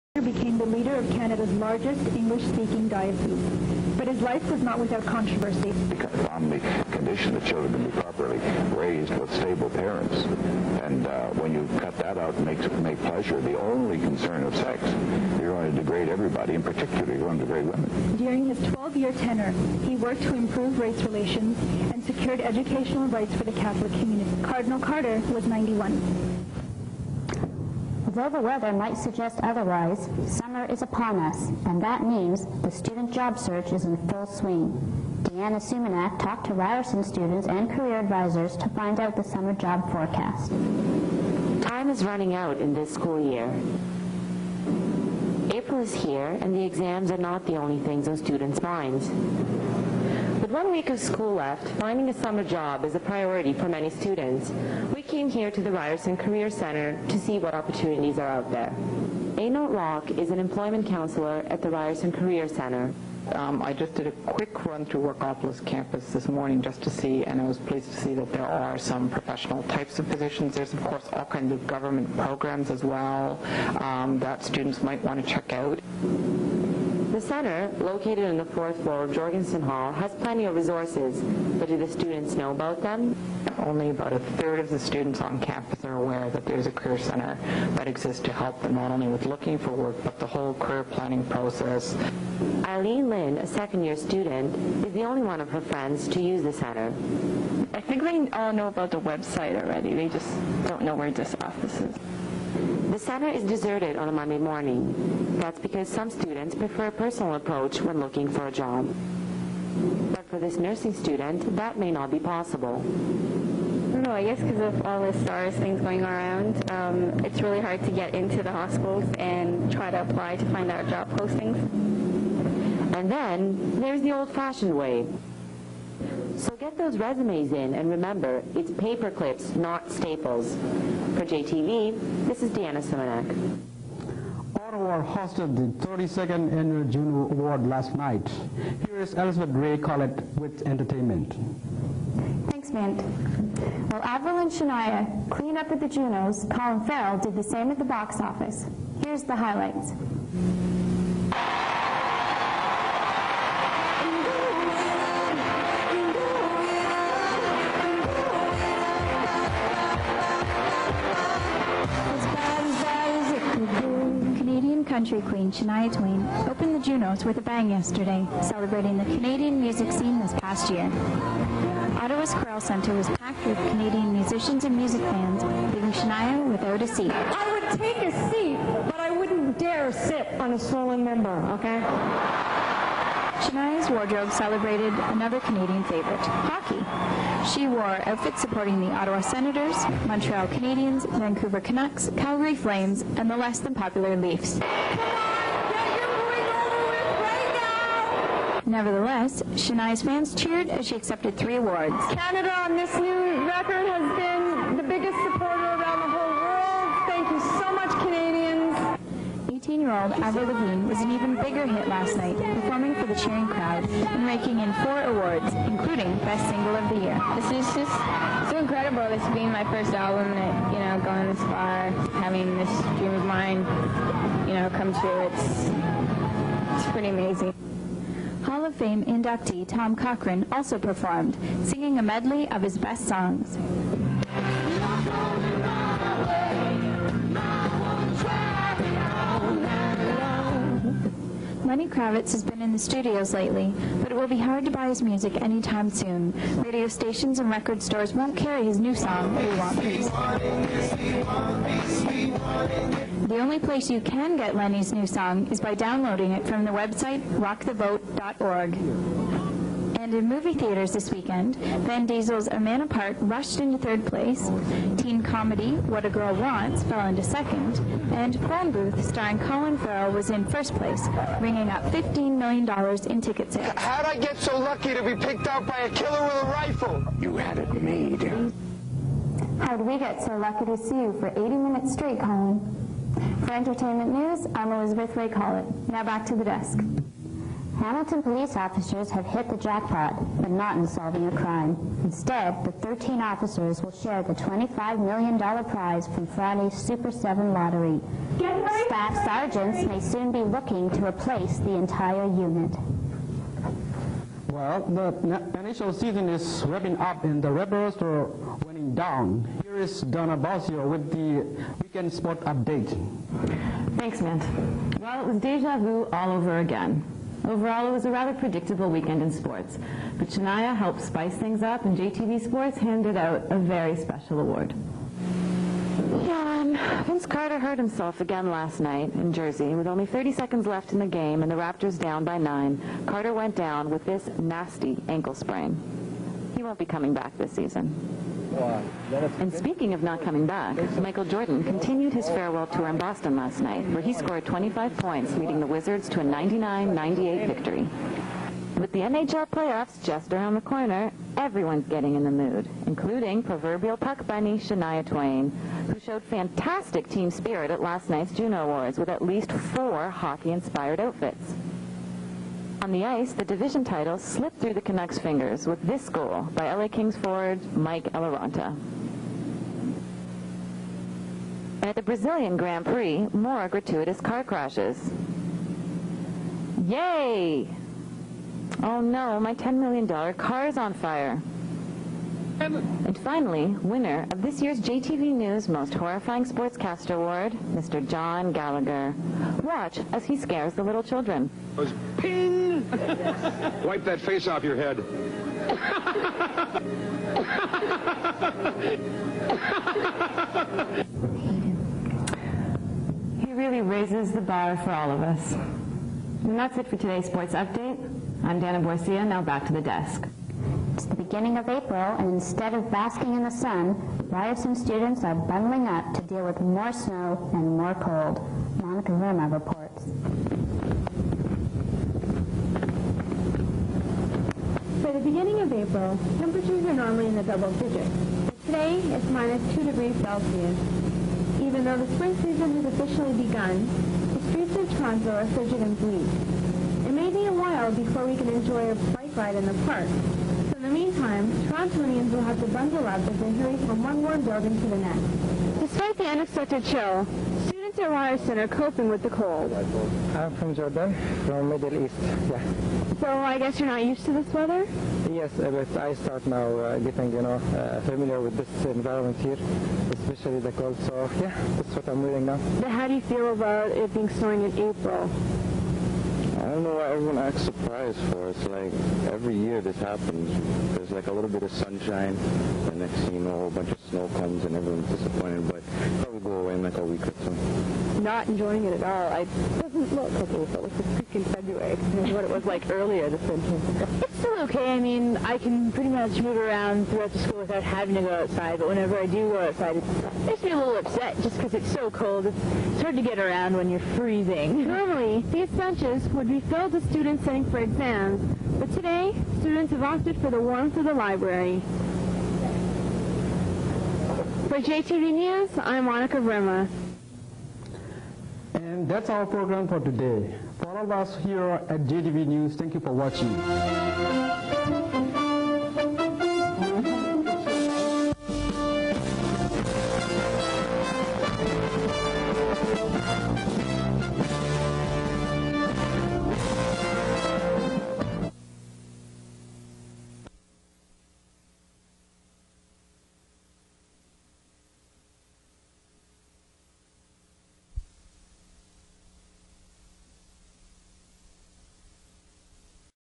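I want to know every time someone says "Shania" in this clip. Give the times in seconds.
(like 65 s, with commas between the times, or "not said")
144 s, 165 s, 175 s, 183 s, 199 s, 320 s, 354 s.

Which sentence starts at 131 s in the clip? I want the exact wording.
For JTV, this is Deanna Simonek.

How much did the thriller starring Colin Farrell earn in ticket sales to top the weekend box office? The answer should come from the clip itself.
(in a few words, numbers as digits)
$15 million.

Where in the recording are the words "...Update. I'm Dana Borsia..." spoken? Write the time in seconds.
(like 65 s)
407 s.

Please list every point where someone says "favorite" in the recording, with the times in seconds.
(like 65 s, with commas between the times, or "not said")
185 s.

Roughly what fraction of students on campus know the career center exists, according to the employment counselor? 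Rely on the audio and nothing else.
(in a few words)
a third.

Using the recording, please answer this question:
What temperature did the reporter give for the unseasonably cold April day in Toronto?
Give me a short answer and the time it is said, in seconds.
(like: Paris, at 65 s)
-2 degrees Celsius, at 429 s.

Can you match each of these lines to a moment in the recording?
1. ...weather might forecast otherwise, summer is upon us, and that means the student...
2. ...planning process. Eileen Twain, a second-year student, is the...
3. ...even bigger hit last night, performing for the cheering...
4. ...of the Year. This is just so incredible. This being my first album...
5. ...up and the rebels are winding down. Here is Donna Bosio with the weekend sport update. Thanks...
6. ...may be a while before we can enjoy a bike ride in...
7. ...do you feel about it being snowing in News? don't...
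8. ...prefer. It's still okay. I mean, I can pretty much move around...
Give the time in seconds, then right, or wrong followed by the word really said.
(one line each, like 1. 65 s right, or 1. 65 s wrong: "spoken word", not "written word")
1. 28 s wrong: "suggest", not "forecast"
2. 90 s wrong: "Lynn", not "Twain"
3. 211 s right
4. 216 s right
5. 306 s right
6. 437 s right
7. 463 s wrong: "April", not "News"
8. 483 s wrong: "winter", not "prefer".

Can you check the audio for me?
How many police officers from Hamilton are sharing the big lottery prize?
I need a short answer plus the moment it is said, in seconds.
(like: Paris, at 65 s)
13, at 292 s.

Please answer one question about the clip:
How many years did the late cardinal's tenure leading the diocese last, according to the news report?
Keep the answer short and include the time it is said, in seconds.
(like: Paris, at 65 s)
12, at 18 s.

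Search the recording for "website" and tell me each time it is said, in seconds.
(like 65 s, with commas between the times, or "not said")
99 s, 256 s.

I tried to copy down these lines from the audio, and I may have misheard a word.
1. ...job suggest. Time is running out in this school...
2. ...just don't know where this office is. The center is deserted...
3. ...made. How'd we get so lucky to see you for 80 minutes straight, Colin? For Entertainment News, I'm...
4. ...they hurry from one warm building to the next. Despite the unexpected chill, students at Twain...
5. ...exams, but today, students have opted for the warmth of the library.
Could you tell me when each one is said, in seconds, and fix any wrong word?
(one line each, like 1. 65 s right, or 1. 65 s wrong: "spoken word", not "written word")
1. 39 s wrong: "forecast", not "suggest"
2. 100 s right
3. 277 s right
4. 443 s wrong: "Ryerson", not "Twain"
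5. 497 s right.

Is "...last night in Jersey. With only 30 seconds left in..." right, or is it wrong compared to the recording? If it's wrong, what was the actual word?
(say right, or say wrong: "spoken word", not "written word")
right.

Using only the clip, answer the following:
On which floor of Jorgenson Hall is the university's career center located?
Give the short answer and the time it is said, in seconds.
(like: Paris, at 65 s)
fourth, at 78 s.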